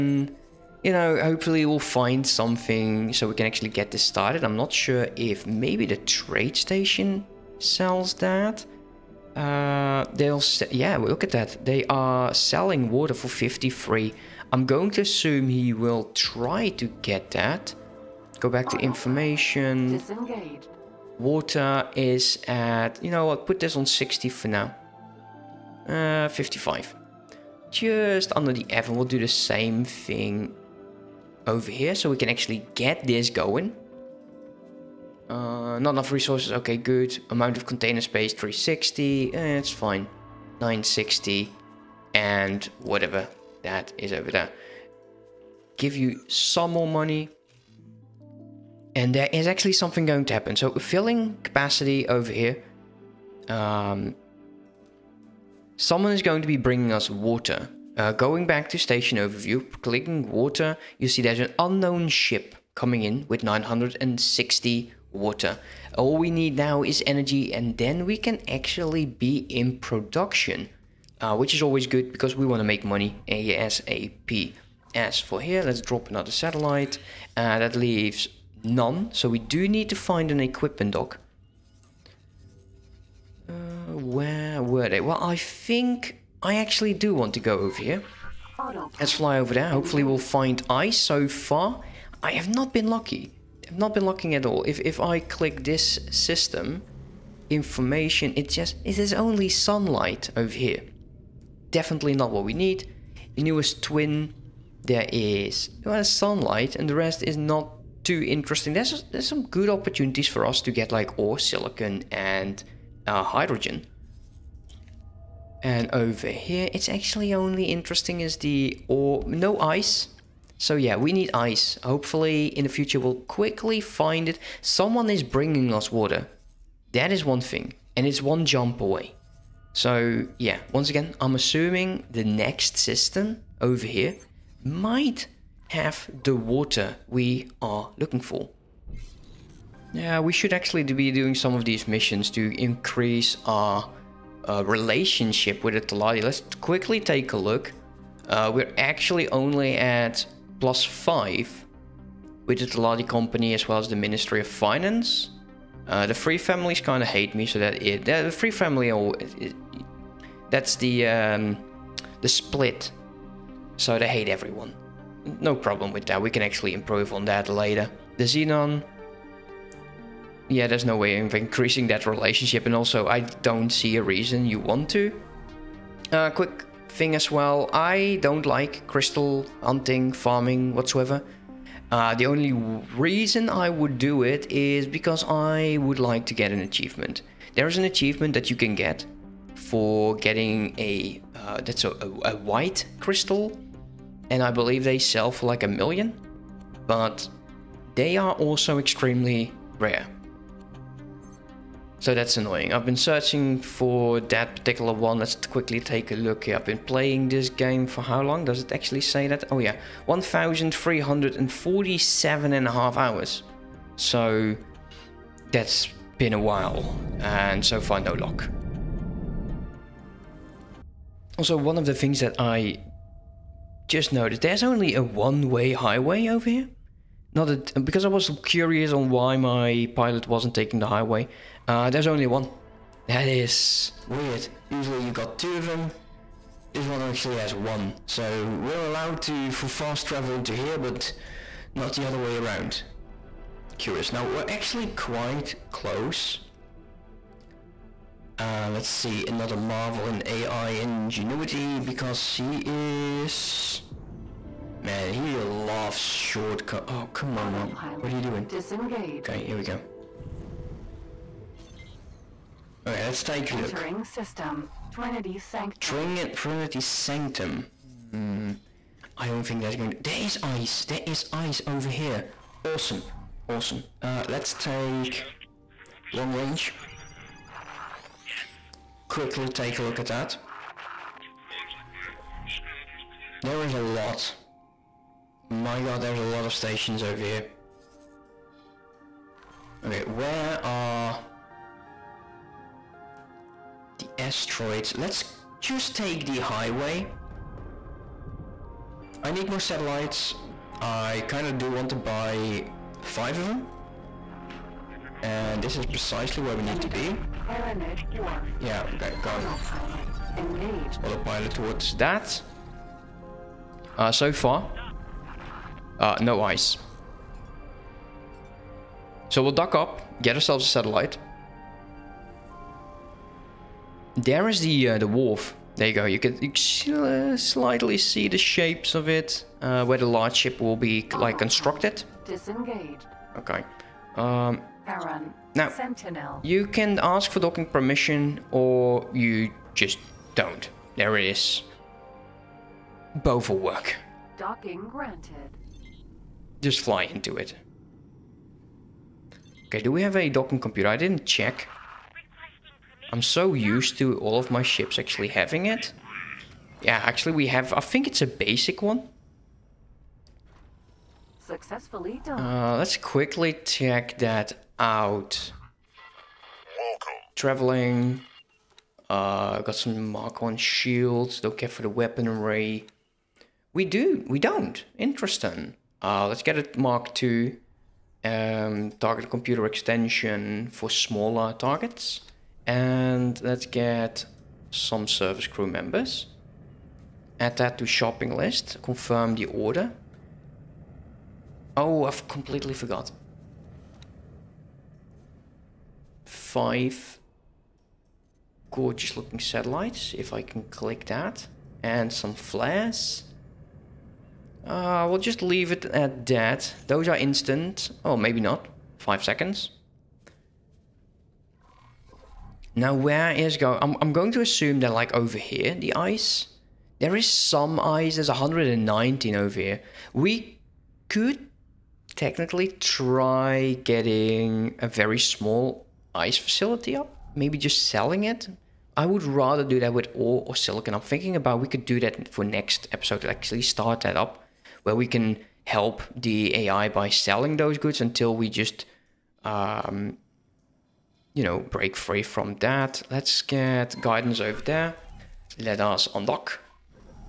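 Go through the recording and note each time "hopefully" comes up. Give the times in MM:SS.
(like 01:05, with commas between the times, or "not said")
00:01, 01:29, 02:01.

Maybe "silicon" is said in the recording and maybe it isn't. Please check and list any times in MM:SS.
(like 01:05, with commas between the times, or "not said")
01:51, 07:10.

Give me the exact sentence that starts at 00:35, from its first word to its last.
Uh, not enough resources, okay, good.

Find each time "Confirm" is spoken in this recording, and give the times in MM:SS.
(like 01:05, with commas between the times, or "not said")
06:28.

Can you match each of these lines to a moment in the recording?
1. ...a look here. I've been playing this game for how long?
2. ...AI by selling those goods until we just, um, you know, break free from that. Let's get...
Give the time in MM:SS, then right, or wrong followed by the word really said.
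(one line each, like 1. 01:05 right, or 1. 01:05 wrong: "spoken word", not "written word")
1. 03:26 right
2. 07:16 right.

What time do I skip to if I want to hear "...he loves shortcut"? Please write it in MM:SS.
04:15.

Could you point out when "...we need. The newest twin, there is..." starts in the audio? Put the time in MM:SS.
01:42.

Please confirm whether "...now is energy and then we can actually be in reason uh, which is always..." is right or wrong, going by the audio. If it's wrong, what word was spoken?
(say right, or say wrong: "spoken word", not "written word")
wrong: "production", not "reason".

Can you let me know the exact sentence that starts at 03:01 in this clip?
Uh, the only reason I would do it is because I would like to get an achievement.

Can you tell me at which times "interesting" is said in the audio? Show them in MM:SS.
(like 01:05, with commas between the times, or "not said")
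01:48, 01:57, 06:14.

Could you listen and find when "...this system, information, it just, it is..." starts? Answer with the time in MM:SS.
01:35.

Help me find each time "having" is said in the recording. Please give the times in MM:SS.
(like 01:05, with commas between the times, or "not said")
05:55.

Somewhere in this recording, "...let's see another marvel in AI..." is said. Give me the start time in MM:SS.
04:08.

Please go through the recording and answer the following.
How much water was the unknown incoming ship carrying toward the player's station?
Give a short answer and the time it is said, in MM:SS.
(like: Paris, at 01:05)
960, at 01:03.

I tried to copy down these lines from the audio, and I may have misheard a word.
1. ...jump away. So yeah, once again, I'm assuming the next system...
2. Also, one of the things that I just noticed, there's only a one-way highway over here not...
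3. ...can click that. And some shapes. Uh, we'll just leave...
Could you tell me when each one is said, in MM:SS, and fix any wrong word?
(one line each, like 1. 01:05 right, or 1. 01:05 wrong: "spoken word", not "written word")
1. 02:08 right
2. 03:41 right
3. 06:40 wrong: "flares", not "shapes".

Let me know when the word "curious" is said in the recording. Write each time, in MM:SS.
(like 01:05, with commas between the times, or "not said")
03:48, 04:03.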